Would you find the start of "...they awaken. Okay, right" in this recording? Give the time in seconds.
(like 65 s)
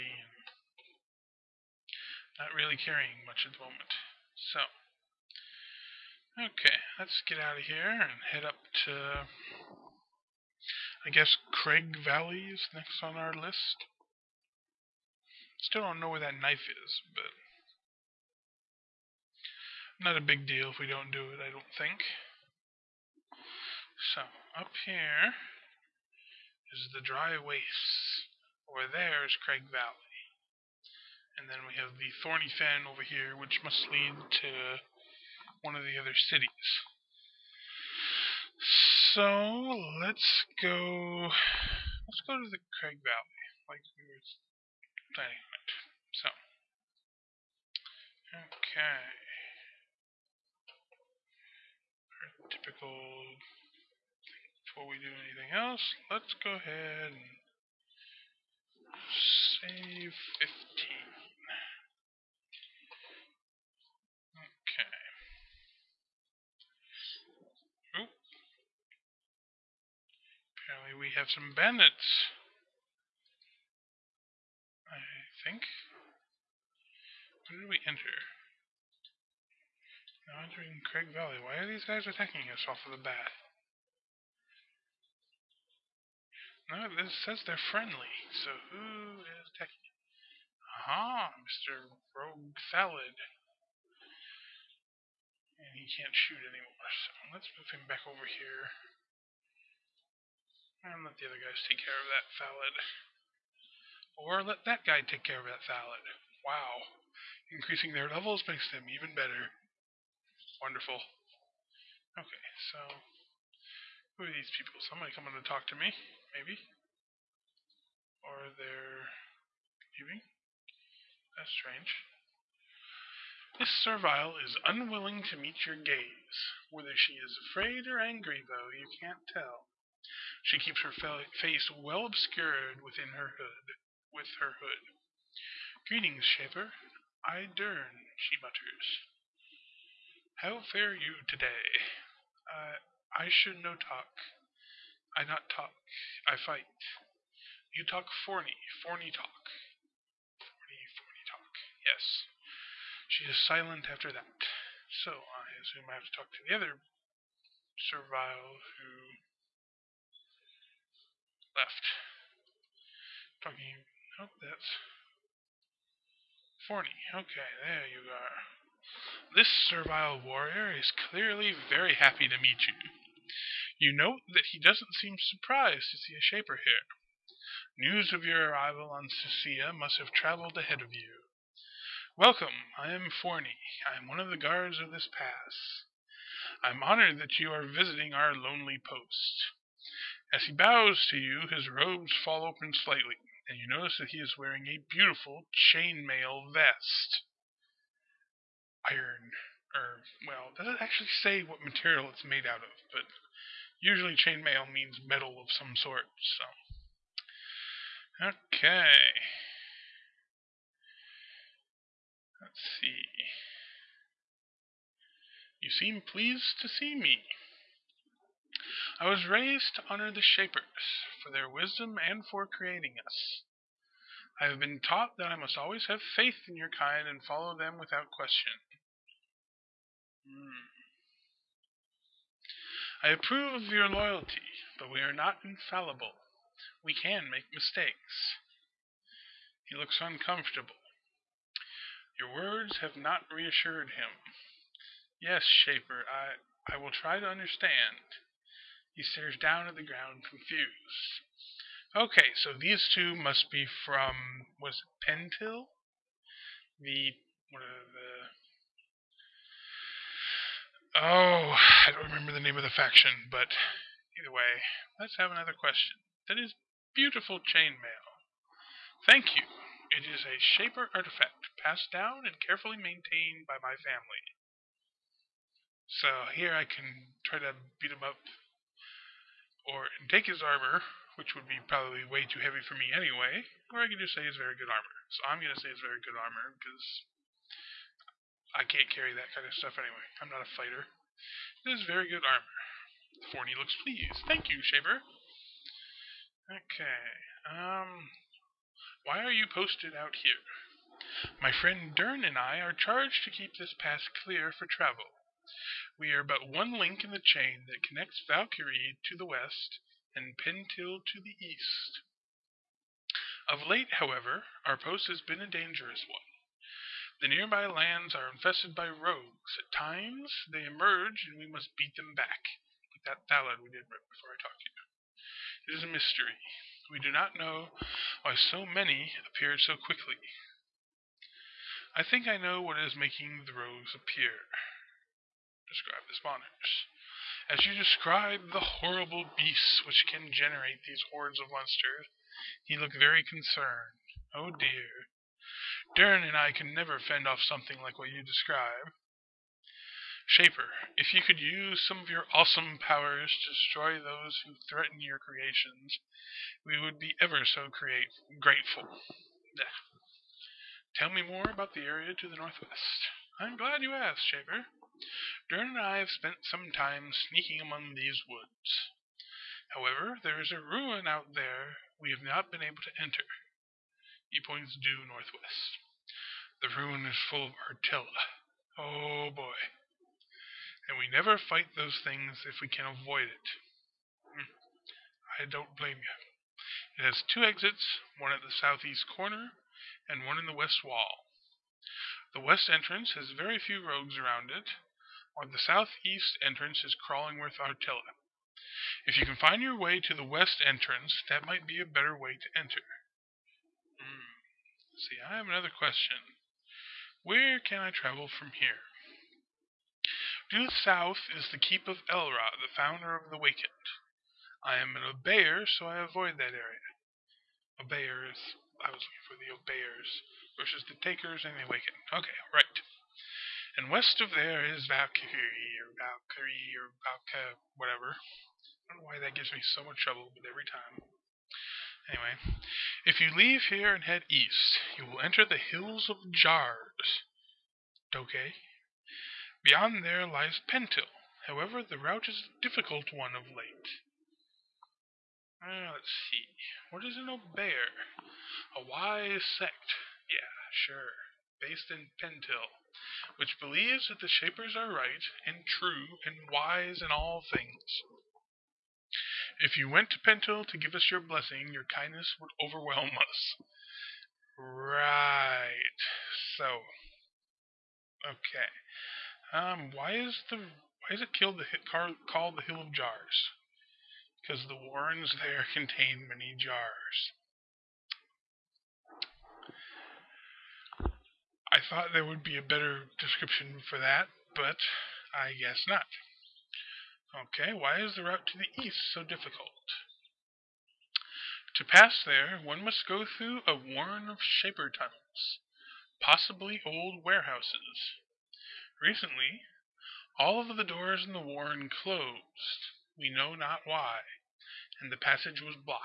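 421 s.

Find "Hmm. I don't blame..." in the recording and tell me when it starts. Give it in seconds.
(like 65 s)
384 s.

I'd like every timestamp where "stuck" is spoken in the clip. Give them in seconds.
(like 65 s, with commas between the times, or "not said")
not said.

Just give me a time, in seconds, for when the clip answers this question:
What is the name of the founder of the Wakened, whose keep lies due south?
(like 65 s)
412 s.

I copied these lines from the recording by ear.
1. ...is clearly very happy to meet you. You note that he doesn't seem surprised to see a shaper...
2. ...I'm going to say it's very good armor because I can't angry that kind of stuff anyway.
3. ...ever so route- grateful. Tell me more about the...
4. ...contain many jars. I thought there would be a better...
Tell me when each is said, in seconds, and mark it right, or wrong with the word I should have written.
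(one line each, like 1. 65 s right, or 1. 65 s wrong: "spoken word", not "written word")
1. 170 s right
2. 285 s wrong: "carry", not "angry"
3. 357 s wrong: "create", not "route"
4. 475 s right.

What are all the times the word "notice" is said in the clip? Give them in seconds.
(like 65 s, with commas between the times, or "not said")
193 s.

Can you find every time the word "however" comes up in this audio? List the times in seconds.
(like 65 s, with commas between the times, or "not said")
314 s, 369 s, 441 s.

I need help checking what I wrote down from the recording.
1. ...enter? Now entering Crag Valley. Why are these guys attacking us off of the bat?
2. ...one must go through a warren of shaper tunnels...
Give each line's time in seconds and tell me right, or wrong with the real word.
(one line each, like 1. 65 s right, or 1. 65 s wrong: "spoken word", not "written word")
1. 77 s right
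2. 492 s right.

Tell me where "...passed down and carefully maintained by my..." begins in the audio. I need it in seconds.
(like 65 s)
271 s.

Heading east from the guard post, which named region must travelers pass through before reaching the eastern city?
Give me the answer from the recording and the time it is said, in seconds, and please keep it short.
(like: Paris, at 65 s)
Hills of Jars, at 435 s.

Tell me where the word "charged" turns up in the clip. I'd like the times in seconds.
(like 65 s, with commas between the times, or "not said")
302 s.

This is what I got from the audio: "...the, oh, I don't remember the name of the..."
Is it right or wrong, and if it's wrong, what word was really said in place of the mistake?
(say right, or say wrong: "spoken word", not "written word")
right.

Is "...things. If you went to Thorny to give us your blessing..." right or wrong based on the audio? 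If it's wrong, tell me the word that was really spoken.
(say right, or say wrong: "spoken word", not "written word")
wrong: "Pentil", not "Thorny".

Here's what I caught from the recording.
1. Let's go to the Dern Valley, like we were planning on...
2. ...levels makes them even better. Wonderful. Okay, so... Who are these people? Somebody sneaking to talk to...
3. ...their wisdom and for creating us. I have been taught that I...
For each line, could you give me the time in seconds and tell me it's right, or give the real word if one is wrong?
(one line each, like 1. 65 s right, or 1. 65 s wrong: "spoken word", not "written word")
1. 42 s wrong: "Crag", not "Dern"
2. 108 s wrong: "coming", not "sneaking"
3. 221 s right.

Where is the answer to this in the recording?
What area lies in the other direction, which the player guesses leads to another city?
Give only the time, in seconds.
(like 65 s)
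32 s.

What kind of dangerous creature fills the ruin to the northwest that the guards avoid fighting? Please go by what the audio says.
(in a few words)
artilla.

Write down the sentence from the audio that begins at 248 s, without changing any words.
He stares down at the ground, confused.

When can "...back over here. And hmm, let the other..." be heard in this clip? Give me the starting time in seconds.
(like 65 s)
97 s.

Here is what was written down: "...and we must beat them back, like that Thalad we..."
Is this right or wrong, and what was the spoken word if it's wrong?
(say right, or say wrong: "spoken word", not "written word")
right.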